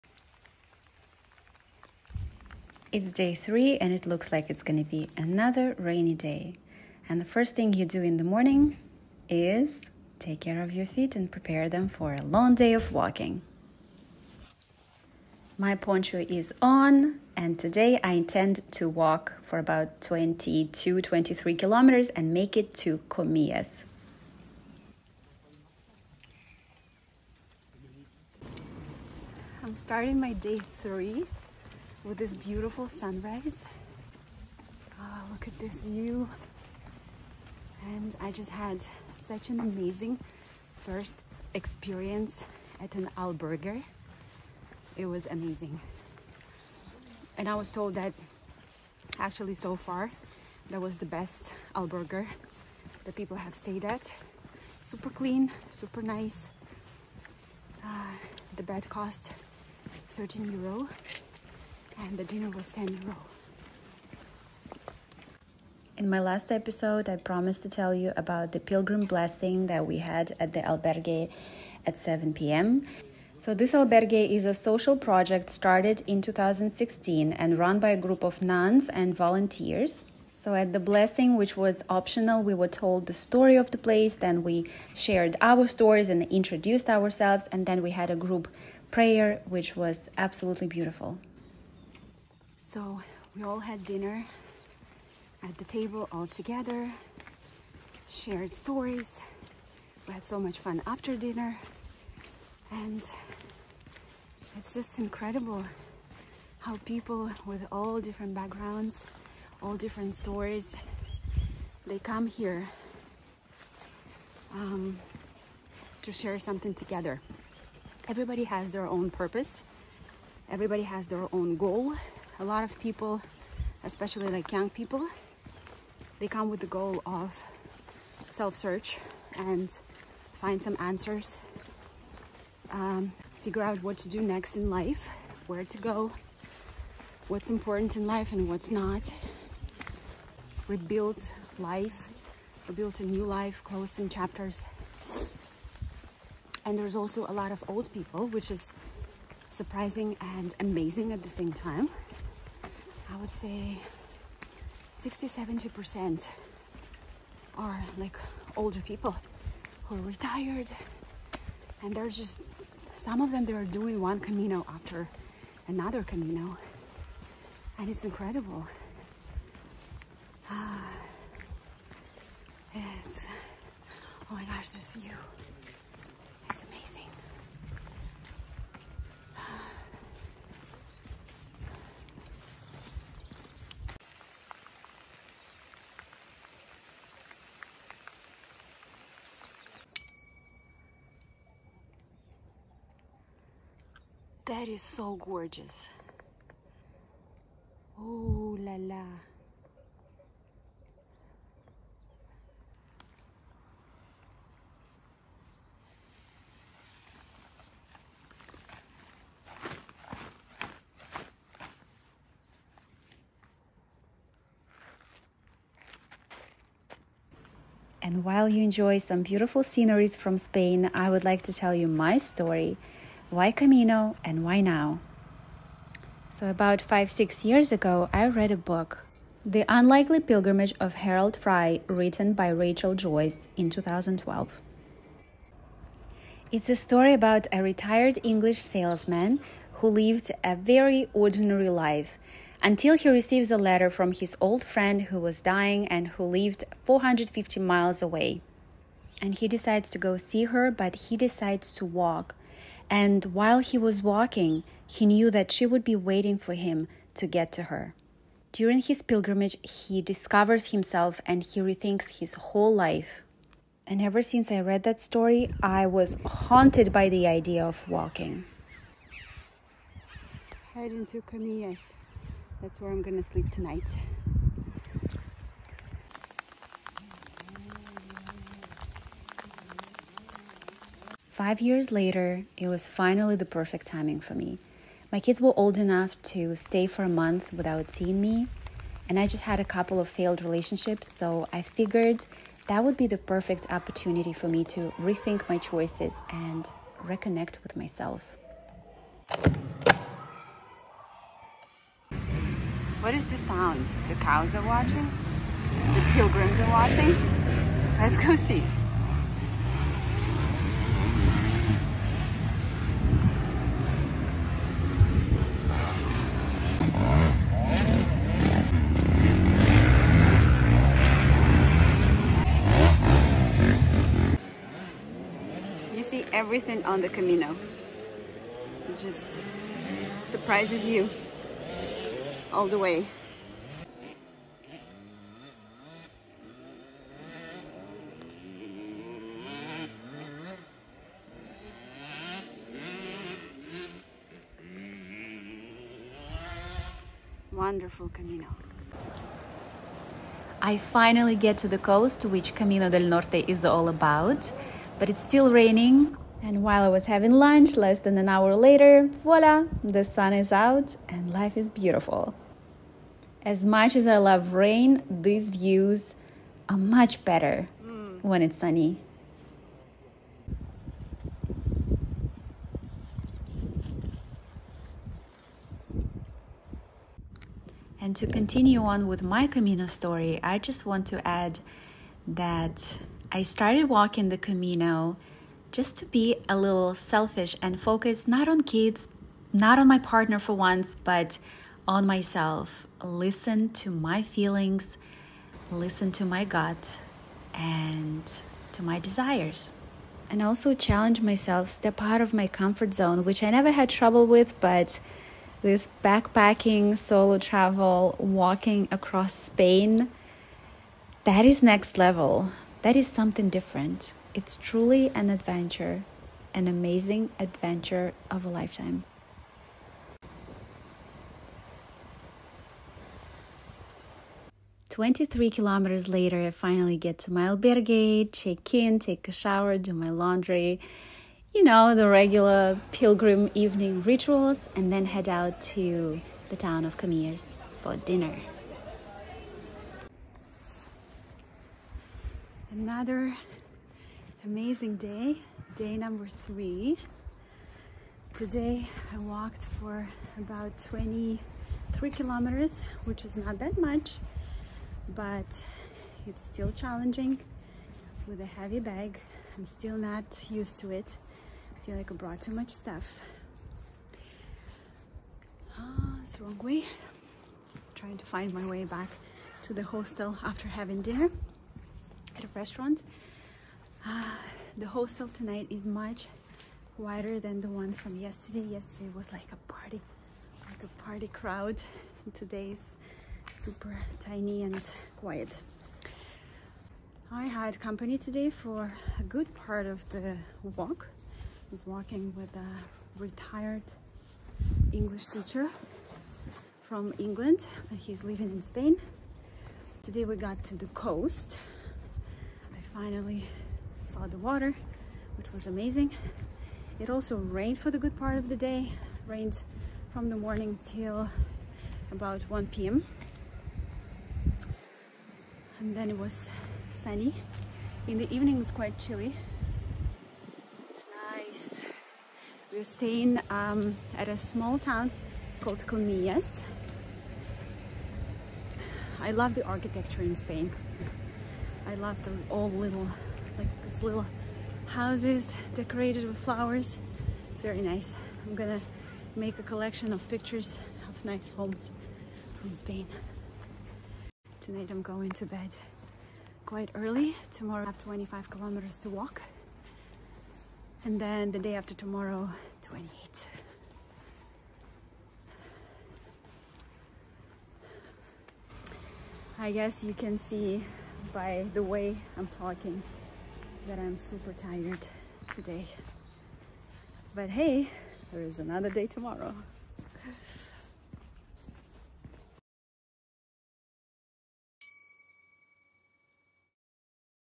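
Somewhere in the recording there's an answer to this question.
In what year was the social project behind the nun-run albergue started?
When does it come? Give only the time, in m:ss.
1:16.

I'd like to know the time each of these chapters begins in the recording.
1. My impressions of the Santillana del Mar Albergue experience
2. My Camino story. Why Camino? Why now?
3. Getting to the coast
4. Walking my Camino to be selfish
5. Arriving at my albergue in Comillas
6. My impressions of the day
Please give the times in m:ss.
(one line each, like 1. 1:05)
1. 0:29
2. 3:38
3. 5:49
4. 6:18
5. 7:05
6. 7:20.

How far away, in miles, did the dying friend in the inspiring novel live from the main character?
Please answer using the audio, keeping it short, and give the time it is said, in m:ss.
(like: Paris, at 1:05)
450 miles, at 4:06.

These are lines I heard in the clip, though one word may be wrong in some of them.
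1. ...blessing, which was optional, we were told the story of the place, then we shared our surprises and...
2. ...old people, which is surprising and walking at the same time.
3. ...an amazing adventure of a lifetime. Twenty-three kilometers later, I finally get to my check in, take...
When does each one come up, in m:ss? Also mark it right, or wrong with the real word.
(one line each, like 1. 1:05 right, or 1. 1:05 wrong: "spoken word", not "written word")
1. 1:20 wrong: "stories", not "surprises"
2. 2:27 wrong: "amazing", not "walking"
3. 6:56 right.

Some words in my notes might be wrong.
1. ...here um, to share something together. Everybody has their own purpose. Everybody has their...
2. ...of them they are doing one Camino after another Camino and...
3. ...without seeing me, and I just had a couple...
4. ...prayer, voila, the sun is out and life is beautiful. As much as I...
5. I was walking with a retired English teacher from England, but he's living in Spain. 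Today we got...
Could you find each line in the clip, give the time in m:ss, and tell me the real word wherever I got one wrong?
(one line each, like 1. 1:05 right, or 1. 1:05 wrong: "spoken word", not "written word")
1. 1:52 right
2. 2:43 right
3. 4:47 right
4. 5:58 wrong: "later", not "prayer"
5. 8:11 right.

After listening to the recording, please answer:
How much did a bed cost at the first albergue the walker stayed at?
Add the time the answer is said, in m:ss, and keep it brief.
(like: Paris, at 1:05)
13 euros, at 1:00.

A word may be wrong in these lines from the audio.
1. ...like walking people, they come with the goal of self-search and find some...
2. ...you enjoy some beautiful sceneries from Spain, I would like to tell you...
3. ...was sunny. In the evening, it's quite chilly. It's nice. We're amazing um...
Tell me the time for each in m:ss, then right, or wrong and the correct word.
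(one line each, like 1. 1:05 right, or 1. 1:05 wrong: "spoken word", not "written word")
1. 2:04 wrong: "young", not "walking"
2. 3:38 right
3. 8:36 wrong: "staying", not "amazing".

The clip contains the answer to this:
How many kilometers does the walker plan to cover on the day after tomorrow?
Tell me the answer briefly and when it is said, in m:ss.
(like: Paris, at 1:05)
28, at 9:12.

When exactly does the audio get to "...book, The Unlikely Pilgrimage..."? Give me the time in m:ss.
3:48.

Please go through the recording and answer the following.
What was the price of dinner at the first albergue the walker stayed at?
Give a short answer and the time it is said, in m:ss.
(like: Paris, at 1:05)
10 euros, at 1:02.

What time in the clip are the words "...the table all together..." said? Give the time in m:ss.
1:35.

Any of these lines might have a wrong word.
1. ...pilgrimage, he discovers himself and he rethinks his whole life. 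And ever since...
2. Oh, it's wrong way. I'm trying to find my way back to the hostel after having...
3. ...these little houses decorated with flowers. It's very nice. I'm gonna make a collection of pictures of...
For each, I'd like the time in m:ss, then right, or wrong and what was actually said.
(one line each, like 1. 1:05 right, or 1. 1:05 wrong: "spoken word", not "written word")
1. 4:19 right
2. 7:45 right
3. 8:53 right.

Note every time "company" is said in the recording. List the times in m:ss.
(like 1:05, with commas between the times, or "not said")
8:07.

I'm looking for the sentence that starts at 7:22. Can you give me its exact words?
another amazing day, day number three.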